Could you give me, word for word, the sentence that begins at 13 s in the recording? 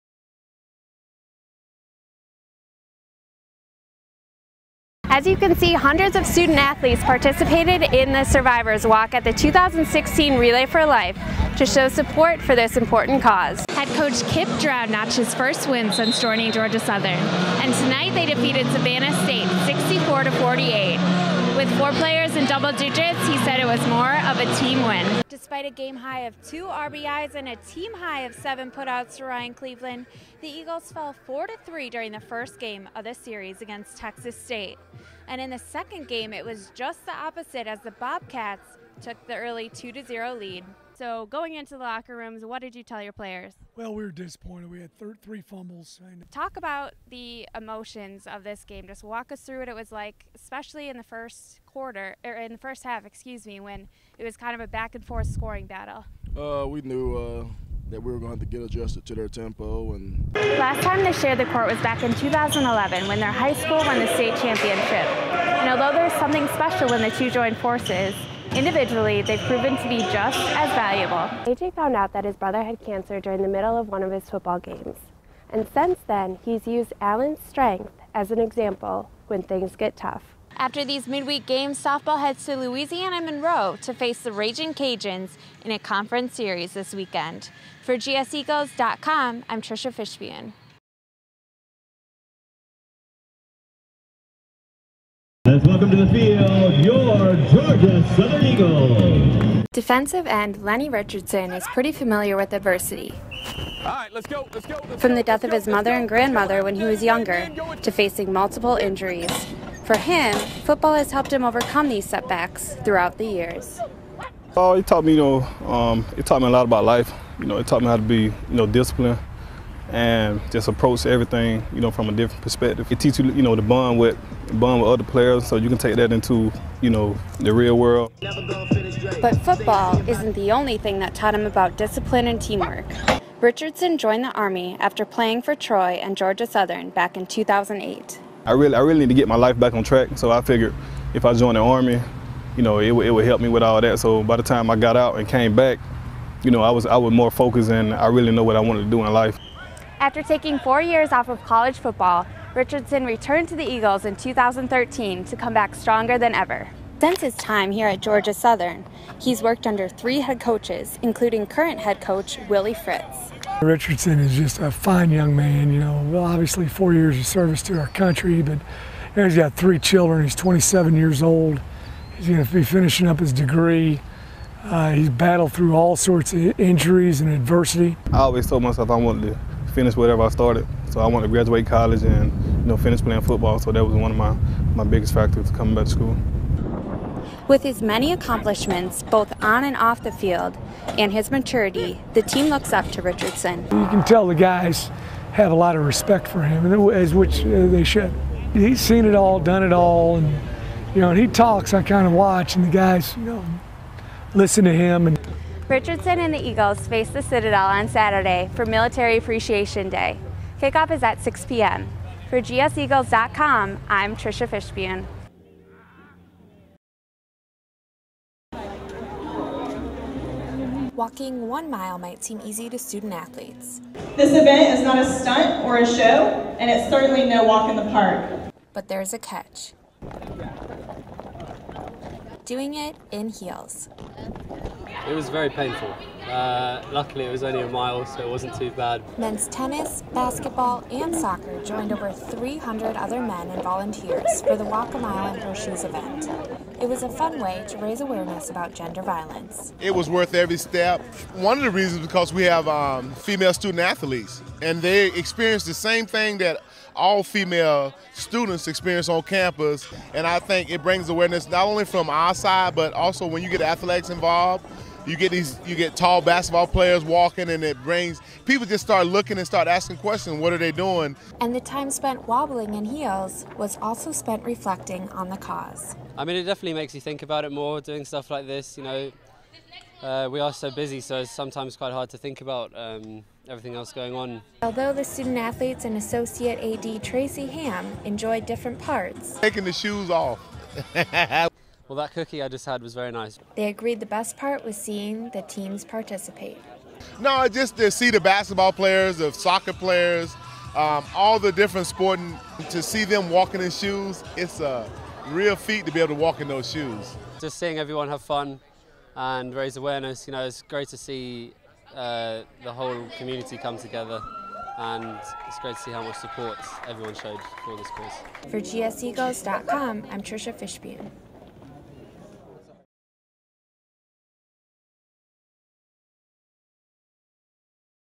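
Head coach Kip Drown notched his first win since joining Georgia Southern, and tonight they defeated Savannah State 64 to 48.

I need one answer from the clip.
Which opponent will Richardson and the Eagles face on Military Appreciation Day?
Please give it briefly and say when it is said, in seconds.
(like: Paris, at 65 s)
The Citadel, at 207 s.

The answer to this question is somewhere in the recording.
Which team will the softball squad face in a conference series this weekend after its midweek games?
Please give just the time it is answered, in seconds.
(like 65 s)
82 s.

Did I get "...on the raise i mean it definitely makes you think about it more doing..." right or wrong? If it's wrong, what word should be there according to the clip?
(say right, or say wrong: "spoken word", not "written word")
wrong: "cause", not "raise".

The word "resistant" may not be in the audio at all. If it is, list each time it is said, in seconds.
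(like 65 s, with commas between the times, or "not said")
not said.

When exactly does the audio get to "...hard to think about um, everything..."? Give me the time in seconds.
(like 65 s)
281 s.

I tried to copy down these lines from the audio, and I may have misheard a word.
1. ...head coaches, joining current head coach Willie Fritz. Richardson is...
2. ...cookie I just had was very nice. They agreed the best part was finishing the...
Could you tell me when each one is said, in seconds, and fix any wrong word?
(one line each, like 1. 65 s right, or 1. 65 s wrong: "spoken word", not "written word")
1. 160 s wrong: "including", not "joining"
2. 292 s wrong: "seeing", not "finishing".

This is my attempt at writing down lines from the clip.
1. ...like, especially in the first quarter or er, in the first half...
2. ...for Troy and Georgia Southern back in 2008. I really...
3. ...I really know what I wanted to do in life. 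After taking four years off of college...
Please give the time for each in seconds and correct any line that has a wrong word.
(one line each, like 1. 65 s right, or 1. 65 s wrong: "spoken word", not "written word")
1. 49 s right
2. 135 s right
3. 147 s right.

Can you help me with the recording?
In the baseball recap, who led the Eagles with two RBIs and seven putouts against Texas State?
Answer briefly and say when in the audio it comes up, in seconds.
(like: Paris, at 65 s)
Ryan Cleveland, at 29 s.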